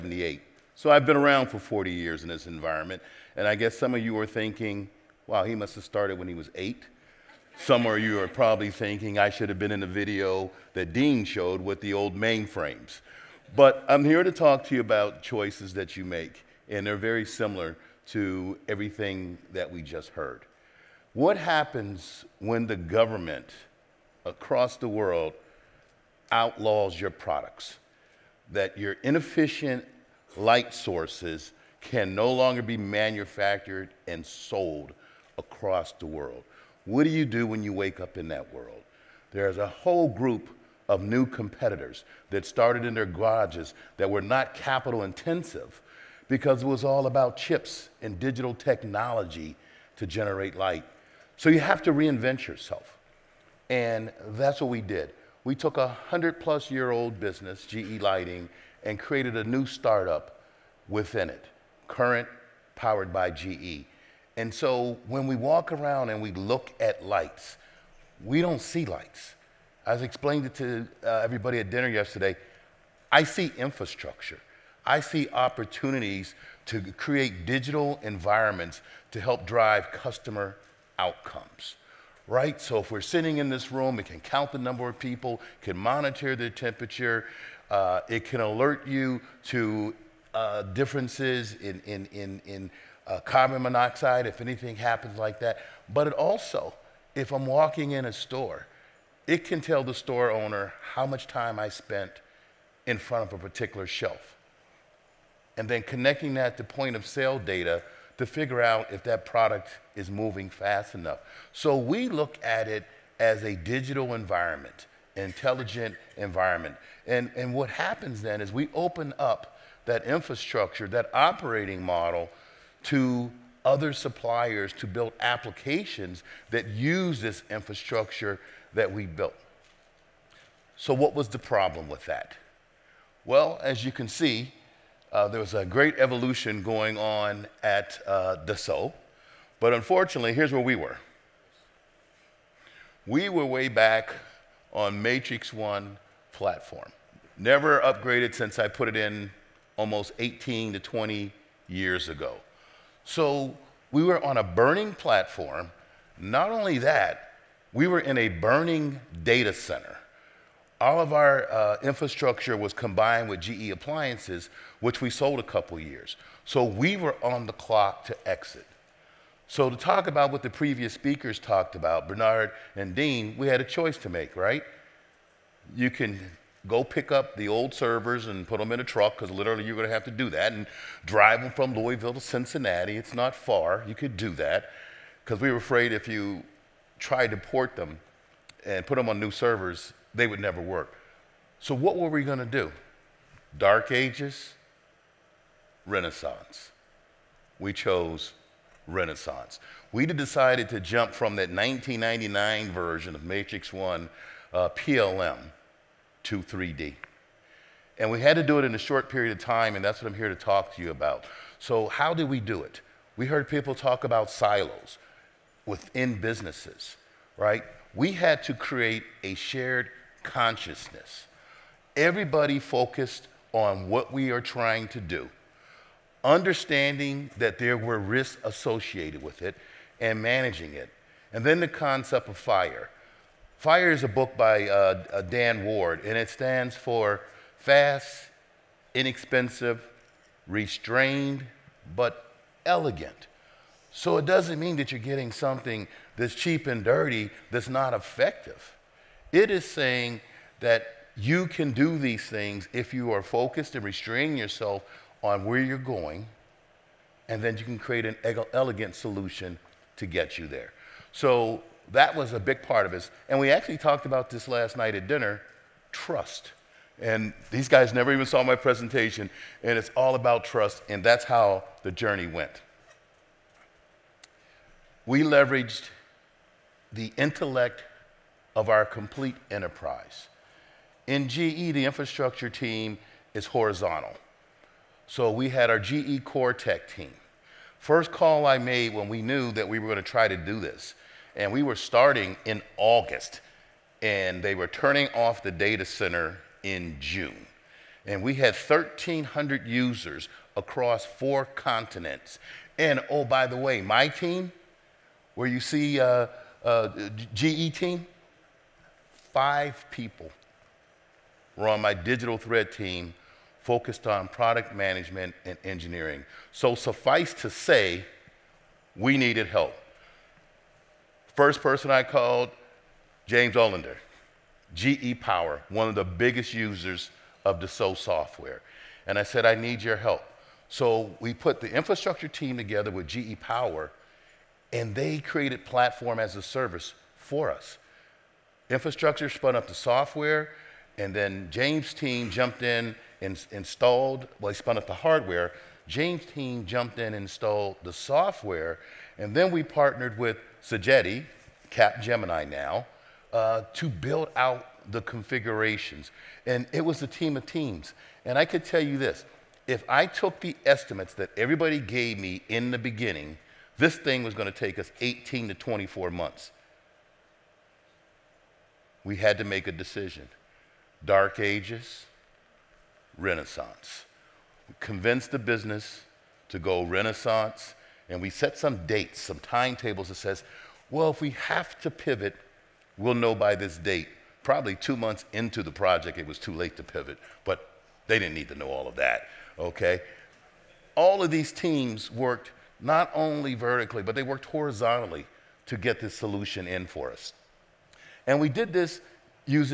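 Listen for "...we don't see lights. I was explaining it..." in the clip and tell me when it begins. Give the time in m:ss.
1:08.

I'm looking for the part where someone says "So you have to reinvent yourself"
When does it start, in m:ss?
0:51.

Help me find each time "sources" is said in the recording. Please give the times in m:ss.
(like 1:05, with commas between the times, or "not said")
0:30.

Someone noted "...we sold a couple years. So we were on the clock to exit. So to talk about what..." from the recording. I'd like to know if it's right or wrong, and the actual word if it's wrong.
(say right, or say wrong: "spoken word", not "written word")
right.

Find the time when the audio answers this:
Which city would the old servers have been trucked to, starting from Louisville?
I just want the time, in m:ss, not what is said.
3:02.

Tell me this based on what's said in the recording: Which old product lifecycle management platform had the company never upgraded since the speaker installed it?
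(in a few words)
Matrix One.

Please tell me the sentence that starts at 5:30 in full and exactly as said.
So we put the infrastructure team together with GE Power, and they created platform as a service for us.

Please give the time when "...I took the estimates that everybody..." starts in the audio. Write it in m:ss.
5:59.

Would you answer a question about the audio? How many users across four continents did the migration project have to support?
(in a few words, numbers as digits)
1,300.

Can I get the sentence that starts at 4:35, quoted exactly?
We leveraged the intellect of our complete enterprise.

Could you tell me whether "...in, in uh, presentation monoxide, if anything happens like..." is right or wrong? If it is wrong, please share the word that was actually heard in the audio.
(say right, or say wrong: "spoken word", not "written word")
wrong: "carbon", not "presentation".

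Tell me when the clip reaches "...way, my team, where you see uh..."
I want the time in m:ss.
5:03.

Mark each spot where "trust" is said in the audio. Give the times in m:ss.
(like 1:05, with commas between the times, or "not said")
4:25, 4:30.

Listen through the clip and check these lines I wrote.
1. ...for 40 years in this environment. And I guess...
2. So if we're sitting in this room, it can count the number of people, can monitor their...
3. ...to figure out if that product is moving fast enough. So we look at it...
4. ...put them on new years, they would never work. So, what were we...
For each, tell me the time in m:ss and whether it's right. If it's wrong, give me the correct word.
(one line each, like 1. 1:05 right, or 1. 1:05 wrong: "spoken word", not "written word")
1. 0:01 right
2. 1:22 right
3. 1:48 right
4. 3:08 wrong: "servers", not "years".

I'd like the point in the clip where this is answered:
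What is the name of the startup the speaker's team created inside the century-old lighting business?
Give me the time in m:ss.
1:01.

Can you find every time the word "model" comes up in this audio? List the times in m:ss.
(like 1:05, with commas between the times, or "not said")
2:01.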